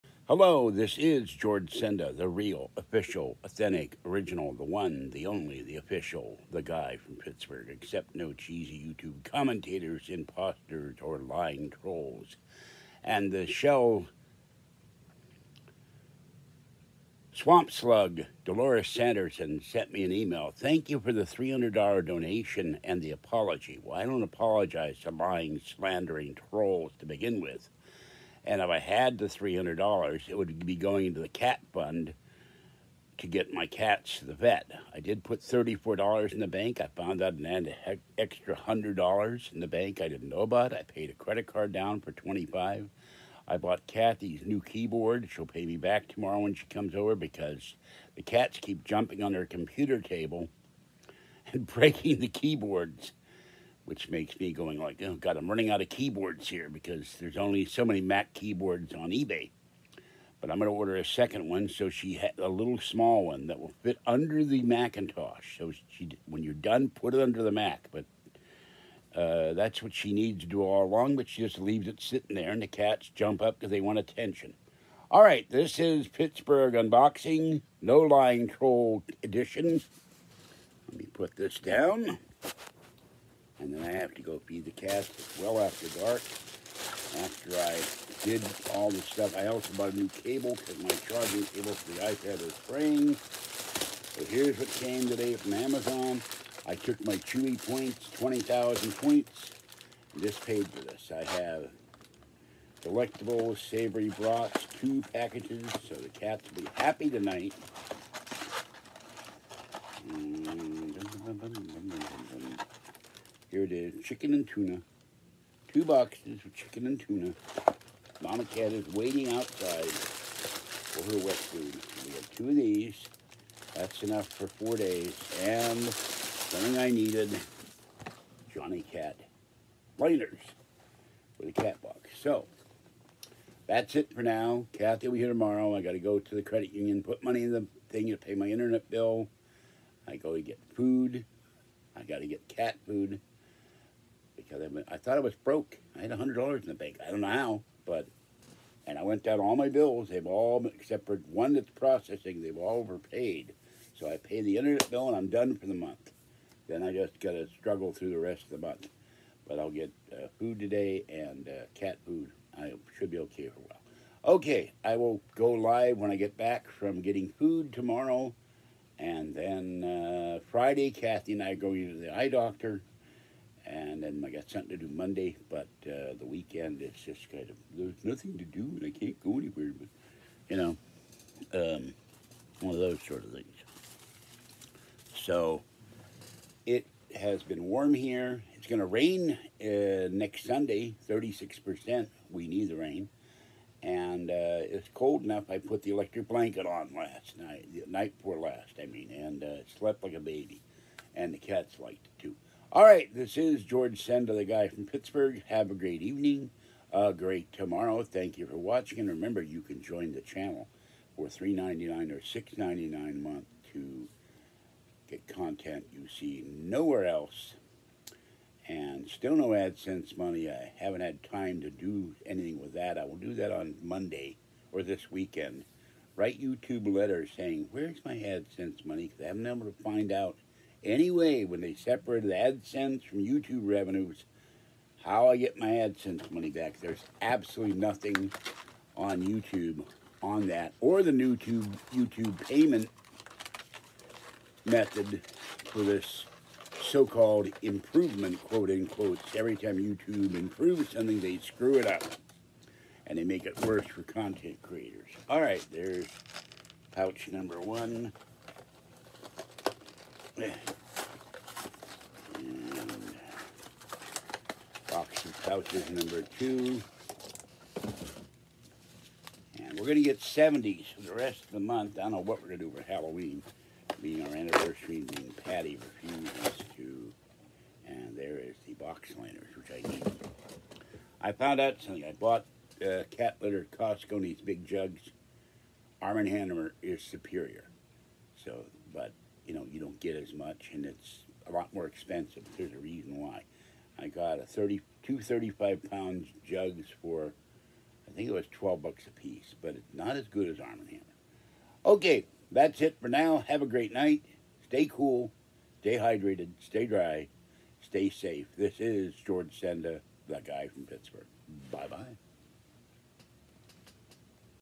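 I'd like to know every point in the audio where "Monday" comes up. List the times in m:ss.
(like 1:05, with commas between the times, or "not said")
2:54, 3:43.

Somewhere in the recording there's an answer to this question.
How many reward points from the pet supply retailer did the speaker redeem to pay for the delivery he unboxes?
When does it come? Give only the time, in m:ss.
1:38.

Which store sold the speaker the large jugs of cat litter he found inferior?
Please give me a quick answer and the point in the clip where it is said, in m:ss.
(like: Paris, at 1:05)
Costco, at 4:43.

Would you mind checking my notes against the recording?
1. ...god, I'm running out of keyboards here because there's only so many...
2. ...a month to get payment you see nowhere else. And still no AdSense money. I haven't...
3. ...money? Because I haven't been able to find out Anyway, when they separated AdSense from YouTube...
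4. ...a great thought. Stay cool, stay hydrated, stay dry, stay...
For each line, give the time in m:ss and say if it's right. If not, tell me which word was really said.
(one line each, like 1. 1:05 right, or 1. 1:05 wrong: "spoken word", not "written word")
1. 0:55 right
2. 3:33 wrong: "content", not "payment"
3. 3:48 right
4. 5:03 wrong: "night", not "thought".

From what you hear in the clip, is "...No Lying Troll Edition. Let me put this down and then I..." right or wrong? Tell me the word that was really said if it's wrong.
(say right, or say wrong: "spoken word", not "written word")
right.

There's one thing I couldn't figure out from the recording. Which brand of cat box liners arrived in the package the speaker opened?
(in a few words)
Jonny Cat.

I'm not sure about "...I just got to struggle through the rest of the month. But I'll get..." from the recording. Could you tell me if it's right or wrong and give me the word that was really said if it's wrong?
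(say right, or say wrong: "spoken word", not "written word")
right.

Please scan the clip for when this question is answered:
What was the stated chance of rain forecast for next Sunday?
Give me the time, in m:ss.
3:11.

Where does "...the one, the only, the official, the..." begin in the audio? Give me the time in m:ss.
0:04.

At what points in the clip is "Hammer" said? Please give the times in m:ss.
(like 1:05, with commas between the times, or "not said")
4:46, 5:00.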